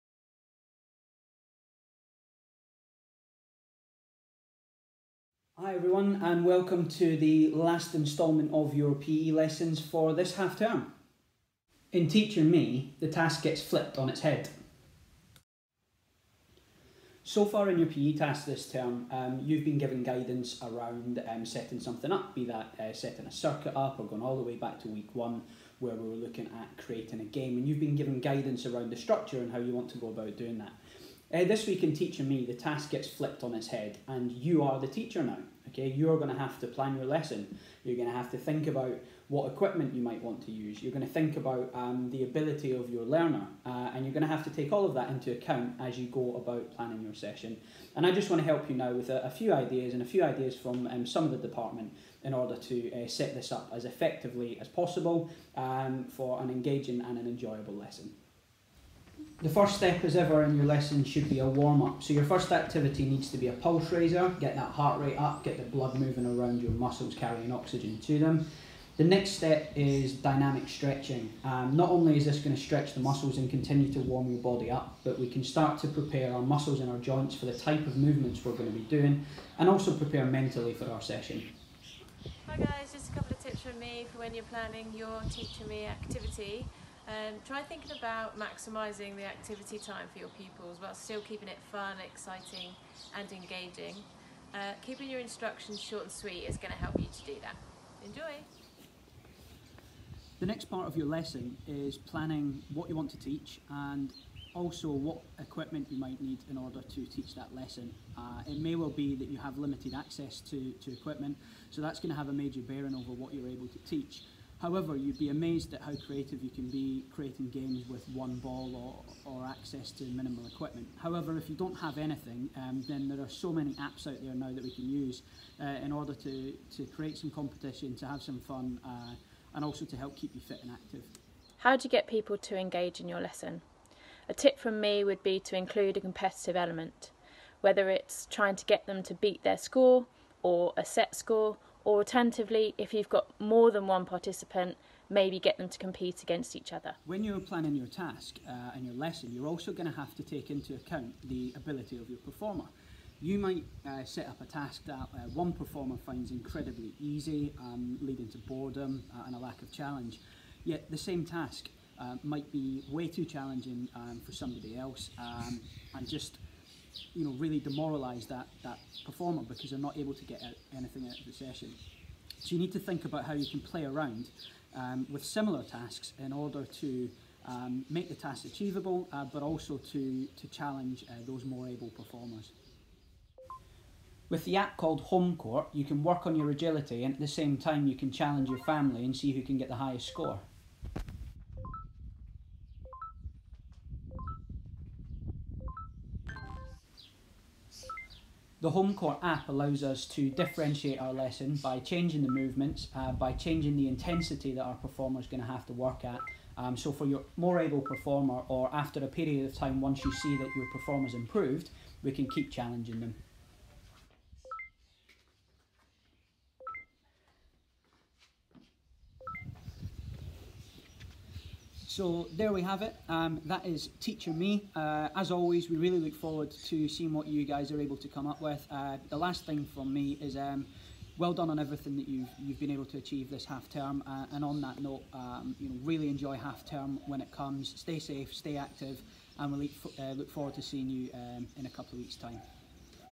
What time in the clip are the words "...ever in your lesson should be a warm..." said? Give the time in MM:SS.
01:00.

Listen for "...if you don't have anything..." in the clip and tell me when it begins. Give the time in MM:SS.
02:01.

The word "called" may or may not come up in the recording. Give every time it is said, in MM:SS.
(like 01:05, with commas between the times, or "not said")
03:04.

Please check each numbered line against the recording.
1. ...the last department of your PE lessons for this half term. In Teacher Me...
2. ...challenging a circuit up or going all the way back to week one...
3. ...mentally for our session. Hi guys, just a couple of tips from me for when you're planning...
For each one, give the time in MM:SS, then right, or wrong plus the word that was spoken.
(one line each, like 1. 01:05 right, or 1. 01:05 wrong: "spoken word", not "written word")
1. 00:07 wrong: "instalment", not "department"
2. 00:22 wrong: "setting", not "challenging"
3. 01:20 right.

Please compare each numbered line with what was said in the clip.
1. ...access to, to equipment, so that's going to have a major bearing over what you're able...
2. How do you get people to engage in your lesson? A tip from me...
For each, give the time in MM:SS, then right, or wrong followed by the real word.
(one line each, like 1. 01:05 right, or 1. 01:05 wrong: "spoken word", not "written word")
1. 01:49 right
2. 02:11 right.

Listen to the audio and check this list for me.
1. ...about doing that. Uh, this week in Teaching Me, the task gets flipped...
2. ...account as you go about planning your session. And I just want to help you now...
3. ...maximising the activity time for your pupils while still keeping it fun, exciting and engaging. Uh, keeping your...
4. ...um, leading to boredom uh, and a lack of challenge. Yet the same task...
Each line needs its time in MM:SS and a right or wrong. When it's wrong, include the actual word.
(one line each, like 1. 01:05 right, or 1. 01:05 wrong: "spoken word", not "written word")
1. 00:30 right
2. 00:45 right
3. 01:28 right
4. 02:37 right.